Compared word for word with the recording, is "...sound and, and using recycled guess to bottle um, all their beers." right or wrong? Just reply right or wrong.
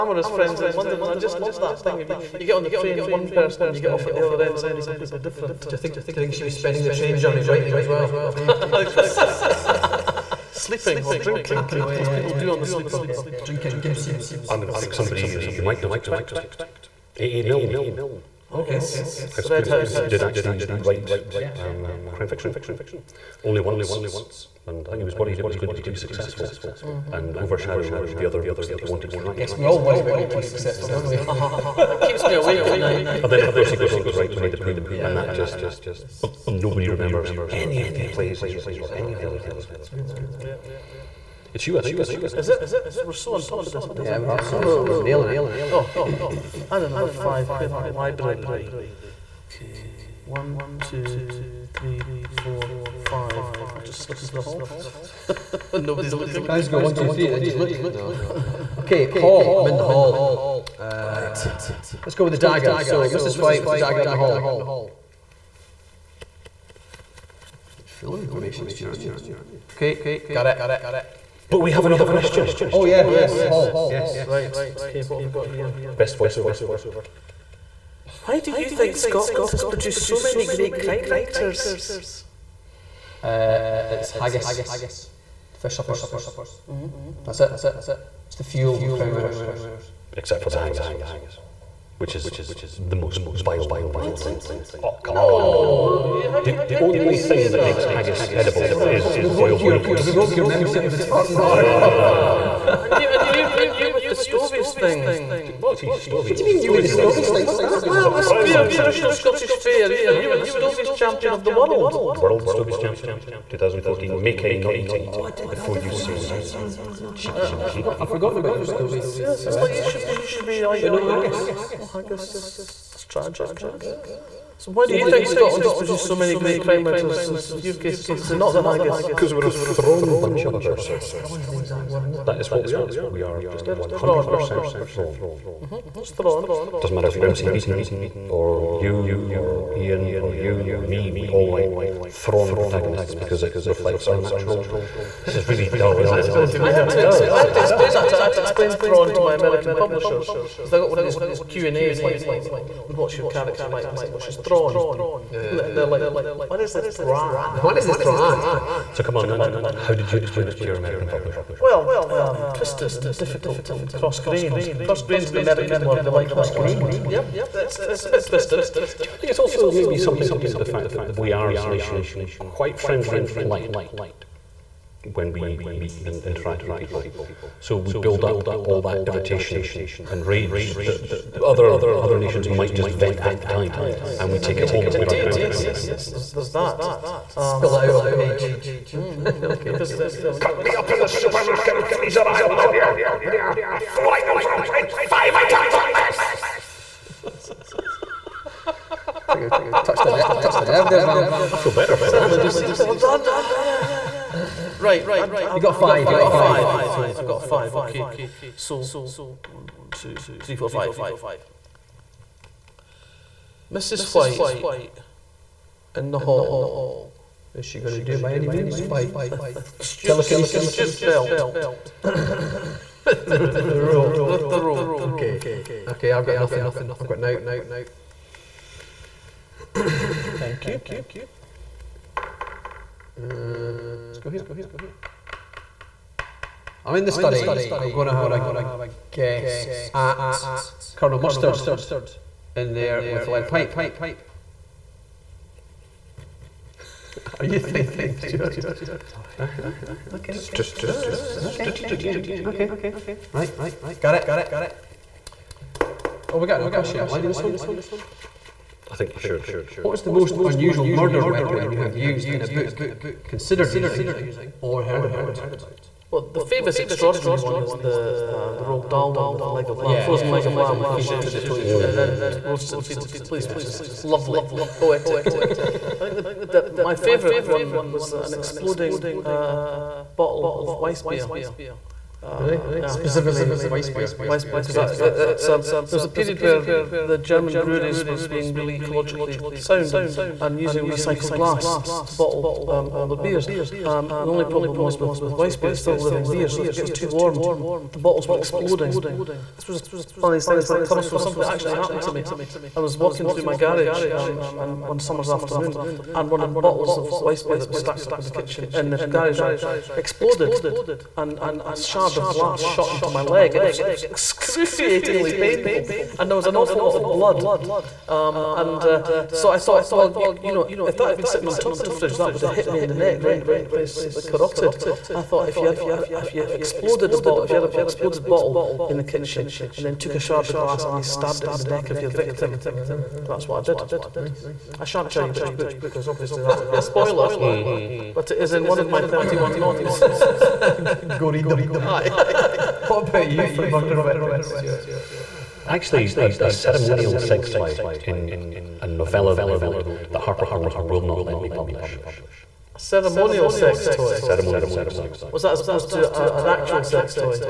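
wrong.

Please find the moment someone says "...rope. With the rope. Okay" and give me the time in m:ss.
3:43.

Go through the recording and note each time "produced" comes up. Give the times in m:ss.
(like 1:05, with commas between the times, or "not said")
1:19, 2:05.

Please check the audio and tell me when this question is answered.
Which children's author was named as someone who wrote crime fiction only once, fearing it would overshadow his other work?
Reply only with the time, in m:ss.
0:17.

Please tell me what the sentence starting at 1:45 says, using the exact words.
What, What do you mean you were the Stovies thing?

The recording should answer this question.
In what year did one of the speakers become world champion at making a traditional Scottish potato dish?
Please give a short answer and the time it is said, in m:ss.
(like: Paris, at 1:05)
2014, at 1:53.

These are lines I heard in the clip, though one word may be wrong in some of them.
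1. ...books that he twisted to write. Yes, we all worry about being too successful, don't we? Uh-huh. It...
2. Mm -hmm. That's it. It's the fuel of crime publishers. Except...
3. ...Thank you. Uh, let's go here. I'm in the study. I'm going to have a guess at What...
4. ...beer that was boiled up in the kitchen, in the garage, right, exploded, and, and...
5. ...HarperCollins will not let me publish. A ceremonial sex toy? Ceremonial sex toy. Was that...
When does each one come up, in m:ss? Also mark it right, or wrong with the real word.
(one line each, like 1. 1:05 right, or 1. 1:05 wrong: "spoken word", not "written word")
1. 0:28 wrong: "wanted", not "twisted"
2. 1:26 wrong: "writers", not "publishers"
3. 3:50 wrong: "Colonel", not "What"
4. 5:07 wrong: "stacked", not "boiled"
5. 5:50 right.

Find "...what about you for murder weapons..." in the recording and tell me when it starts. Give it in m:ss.
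5:42.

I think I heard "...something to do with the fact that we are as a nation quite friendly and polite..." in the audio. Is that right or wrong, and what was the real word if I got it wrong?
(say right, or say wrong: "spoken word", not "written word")
right.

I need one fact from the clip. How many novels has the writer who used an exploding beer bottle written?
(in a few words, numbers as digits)
31.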